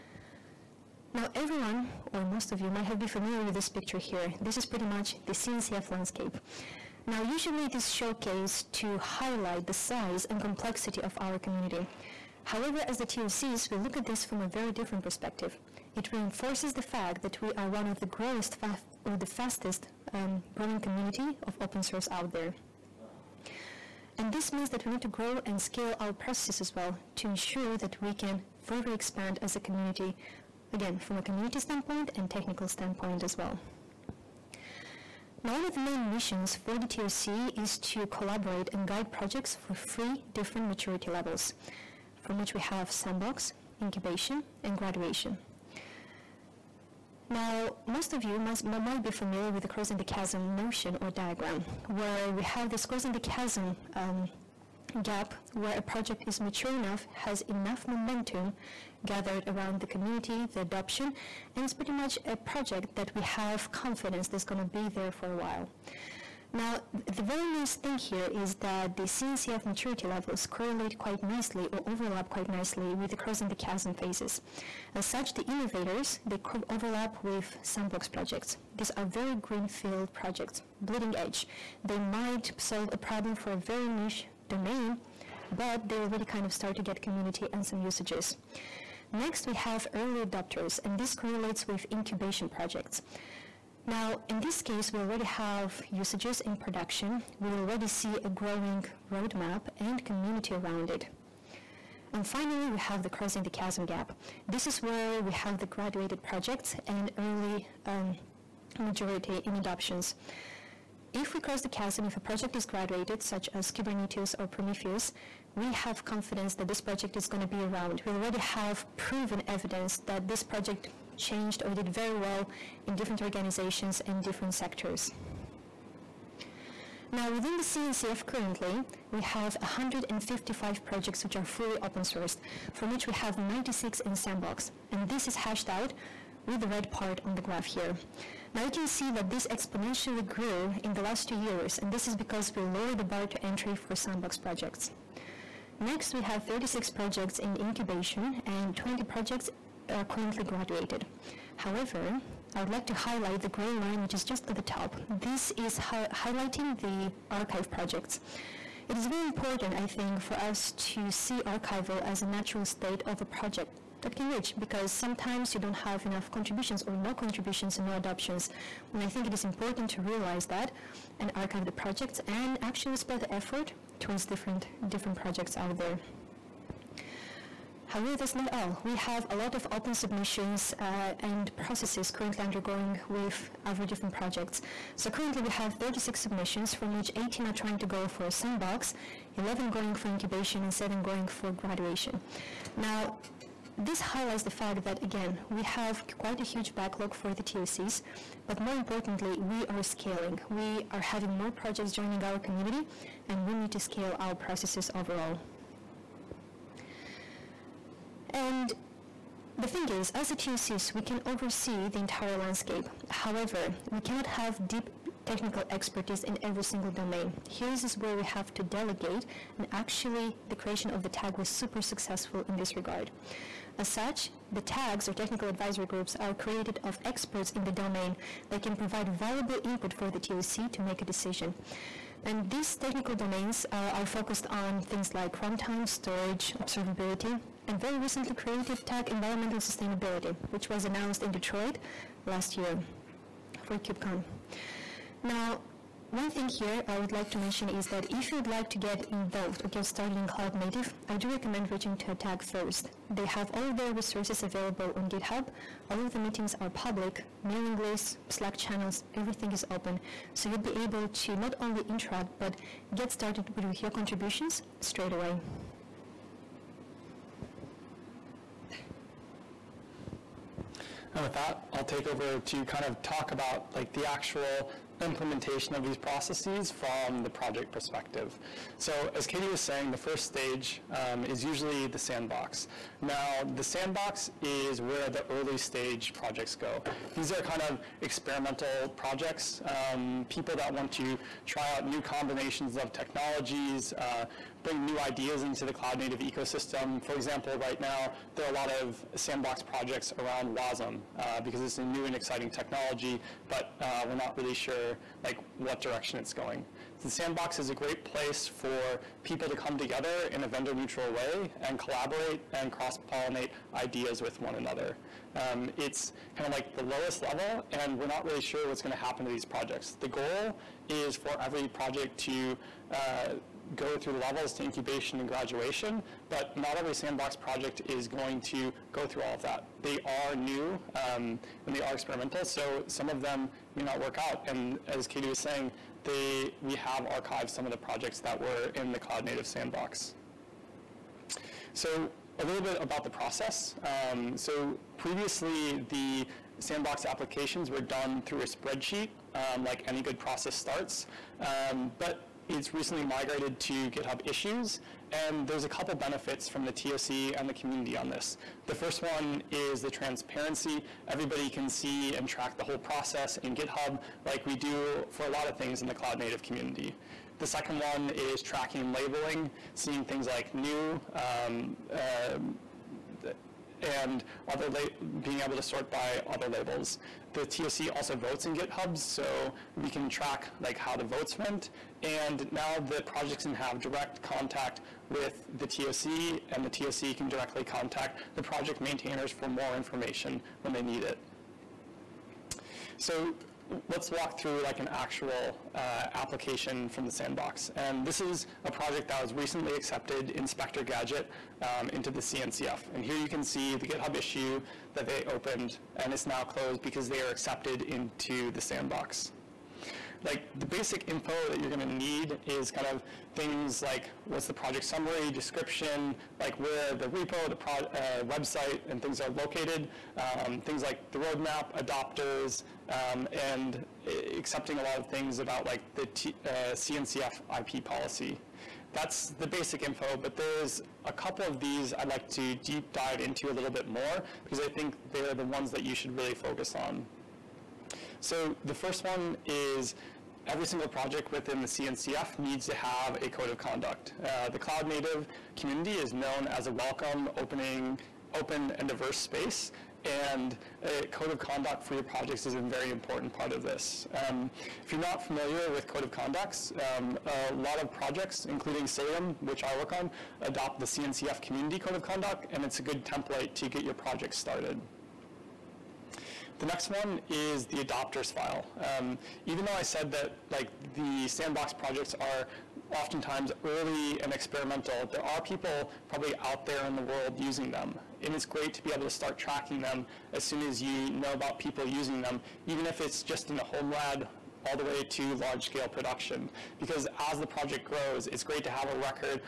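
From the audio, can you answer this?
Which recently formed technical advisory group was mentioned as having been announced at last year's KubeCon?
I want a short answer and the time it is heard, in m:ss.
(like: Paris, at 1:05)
Environmental sustainability, at 3:59.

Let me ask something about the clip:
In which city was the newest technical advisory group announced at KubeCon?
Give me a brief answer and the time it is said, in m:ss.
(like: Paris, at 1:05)
Detroit, at 4:01.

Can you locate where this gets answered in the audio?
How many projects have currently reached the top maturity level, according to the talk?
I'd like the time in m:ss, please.
2:28.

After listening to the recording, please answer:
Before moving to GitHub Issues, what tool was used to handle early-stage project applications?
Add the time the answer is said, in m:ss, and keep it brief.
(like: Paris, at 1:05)
A spreadsheet, at 5:48.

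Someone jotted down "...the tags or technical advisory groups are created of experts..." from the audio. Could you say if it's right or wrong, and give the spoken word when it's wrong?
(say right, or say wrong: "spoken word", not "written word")
right.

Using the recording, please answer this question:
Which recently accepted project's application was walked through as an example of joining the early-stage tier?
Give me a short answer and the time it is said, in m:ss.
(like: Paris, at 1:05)
Inspector Gadget, at 6:40.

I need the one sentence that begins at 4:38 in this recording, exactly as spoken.
So as Katie was saying, the first stage um, is usually the sandbox.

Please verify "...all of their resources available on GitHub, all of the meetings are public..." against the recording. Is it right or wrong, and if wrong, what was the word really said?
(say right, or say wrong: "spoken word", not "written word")
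right.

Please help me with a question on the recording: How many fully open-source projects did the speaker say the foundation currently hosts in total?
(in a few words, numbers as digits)
155.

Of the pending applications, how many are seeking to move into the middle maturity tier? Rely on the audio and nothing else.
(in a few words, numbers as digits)
11.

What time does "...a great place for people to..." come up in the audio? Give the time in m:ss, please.
5:07.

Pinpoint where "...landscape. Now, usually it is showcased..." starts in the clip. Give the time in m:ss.
0:05.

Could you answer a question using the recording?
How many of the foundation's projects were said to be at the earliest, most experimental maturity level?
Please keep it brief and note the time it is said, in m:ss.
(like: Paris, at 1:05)
96, at 2:13.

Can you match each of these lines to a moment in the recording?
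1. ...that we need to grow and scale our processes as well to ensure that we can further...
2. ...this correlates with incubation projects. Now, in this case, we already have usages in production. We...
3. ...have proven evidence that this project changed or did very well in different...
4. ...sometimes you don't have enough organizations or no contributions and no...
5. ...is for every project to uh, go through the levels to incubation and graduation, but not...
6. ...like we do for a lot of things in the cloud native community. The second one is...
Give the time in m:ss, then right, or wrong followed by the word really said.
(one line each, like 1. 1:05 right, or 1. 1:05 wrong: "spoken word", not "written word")
1. 0:24 right
2. 1:30 right
3. 1:58 right
4. 2:44 wrong: "contributions", not "organizations"
5. 5:20 right
6. 6:04 right.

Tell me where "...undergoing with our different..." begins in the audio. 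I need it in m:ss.
3:02.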